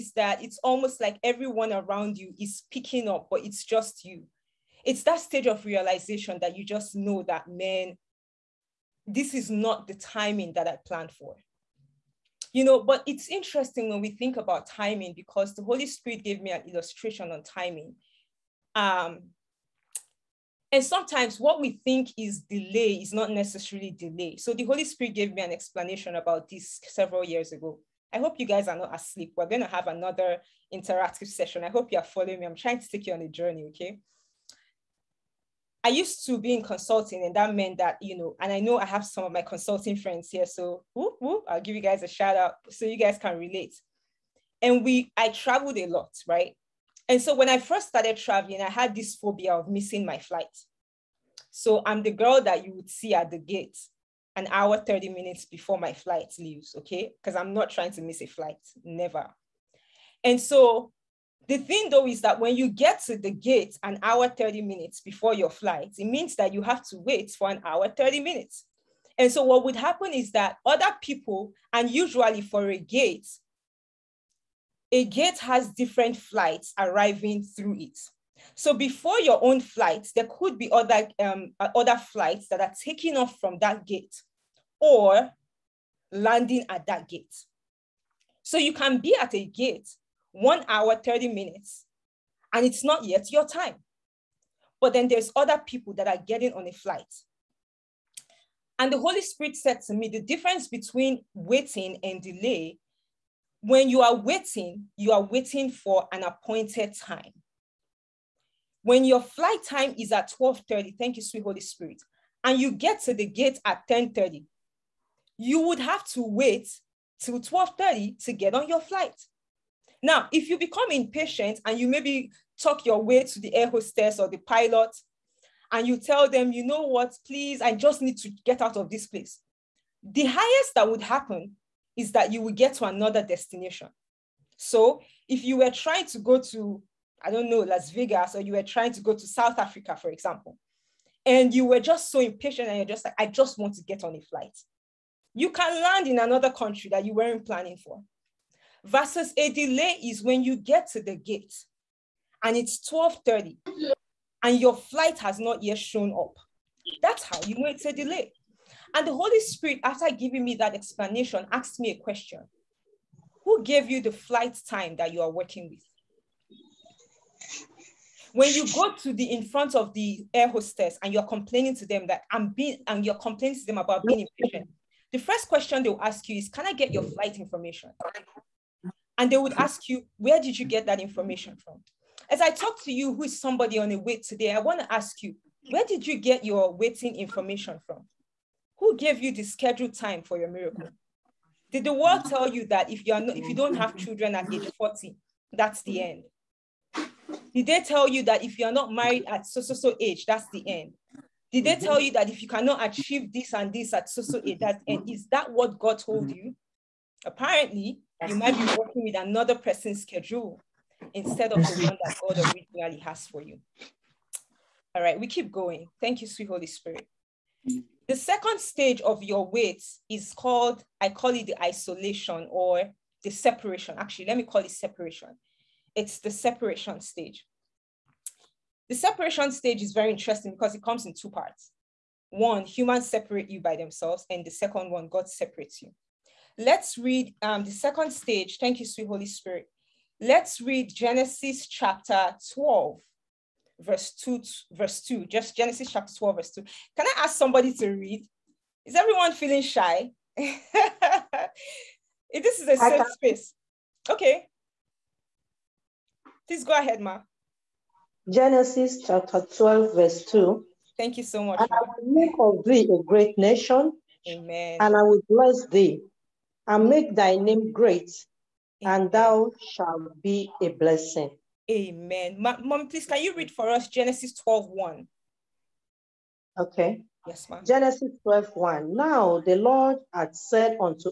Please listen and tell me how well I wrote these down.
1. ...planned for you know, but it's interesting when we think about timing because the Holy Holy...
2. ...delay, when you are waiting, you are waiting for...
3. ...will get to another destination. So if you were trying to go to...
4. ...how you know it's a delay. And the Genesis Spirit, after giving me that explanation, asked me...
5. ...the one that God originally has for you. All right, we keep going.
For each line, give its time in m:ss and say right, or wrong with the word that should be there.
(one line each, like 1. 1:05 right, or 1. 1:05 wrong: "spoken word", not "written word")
1. 0:10 wrong: "Spirit", not "Holy"
2. 1:42 right
3. 2:12 right
4. 2:37 wrong: "Holy", not "Genesis"
5. 3:31 right.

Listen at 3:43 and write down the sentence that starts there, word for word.
Actually, let me call it separation.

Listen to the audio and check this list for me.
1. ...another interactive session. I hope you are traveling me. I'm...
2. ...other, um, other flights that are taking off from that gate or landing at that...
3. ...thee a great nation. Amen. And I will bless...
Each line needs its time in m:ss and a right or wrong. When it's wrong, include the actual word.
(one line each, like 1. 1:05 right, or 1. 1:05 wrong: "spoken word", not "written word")
1. 0:29 wrong: "following", not "traveling"
2. 1:20 right
3. 4:22 right.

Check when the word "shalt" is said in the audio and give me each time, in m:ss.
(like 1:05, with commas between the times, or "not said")
4:29.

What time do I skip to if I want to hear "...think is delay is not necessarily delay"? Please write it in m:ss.
0:21.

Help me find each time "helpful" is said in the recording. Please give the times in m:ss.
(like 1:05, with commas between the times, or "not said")
not said.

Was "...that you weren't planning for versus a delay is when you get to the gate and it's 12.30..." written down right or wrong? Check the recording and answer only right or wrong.
right.